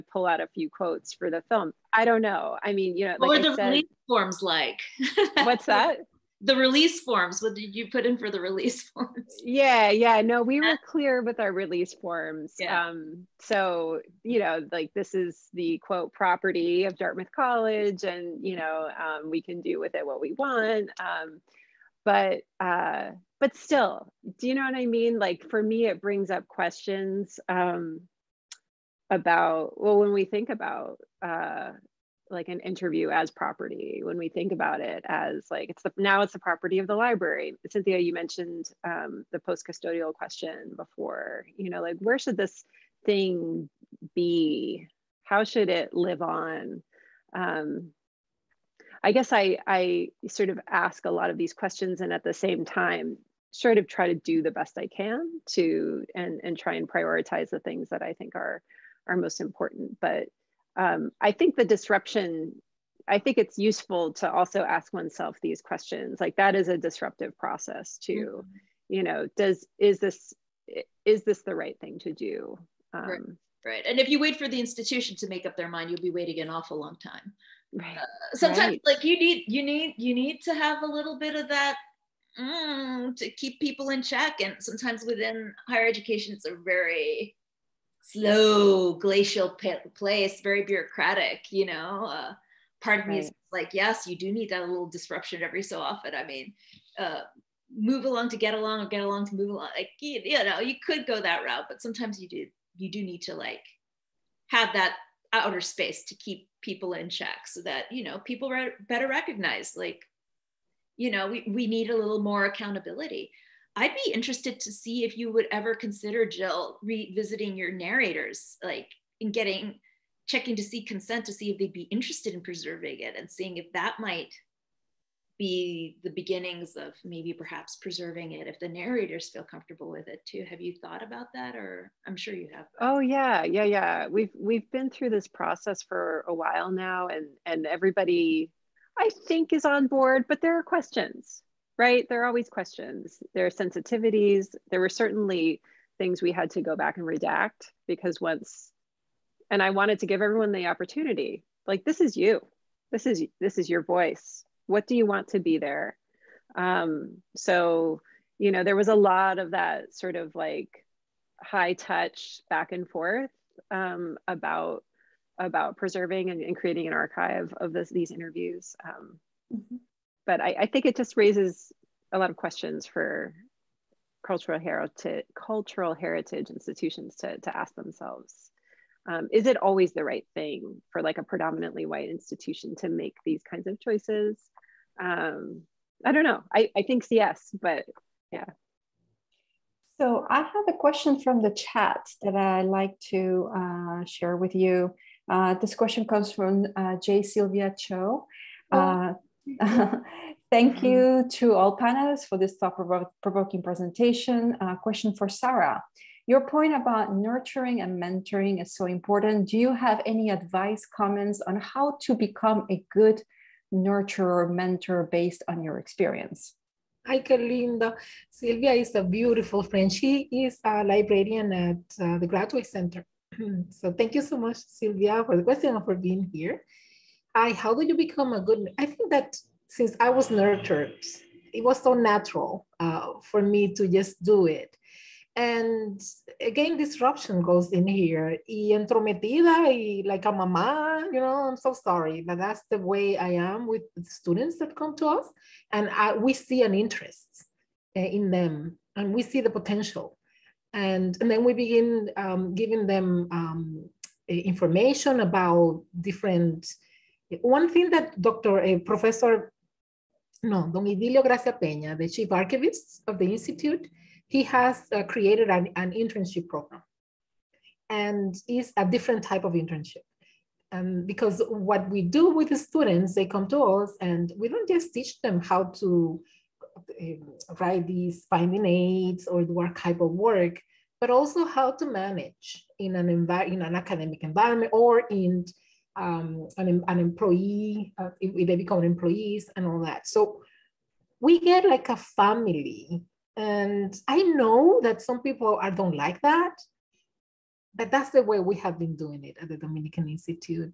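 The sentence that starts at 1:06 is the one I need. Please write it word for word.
Like that is a disruptive process too.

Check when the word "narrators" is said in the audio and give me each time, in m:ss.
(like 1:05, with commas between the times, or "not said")
1:57, 2:08.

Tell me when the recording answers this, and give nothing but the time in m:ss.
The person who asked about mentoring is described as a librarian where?
3:42.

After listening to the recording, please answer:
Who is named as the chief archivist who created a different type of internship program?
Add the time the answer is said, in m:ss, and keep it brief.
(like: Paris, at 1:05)
Idilio Gracia Peña, at 4:20.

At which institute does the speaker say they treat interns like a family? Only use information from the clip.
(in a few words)
the Dominican Institute.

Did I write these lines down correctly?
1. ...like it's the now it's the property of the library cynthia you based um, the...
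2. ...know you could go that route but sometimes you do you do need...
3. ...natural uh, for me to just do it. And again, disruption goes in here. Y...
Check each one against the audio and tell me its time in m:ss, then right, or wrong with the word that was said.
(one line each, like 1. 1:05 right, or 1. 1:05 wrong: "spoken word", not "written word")
1. 0:35 wrong: "mentioned", not "based"
2. 1:40 right
3. 3:51 right.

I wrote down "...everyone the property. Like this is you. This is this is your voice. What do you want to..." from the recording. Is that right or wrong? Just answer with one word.
wrong.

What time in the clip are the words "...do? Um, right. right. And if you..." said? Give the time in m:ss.
1:12.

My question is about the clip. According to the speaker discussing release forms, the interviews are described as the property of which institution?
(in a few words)
Dartmouth College.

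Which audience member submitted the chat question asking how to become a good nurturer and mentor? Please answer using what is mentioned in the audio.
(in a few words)
J. Sylvia Cho.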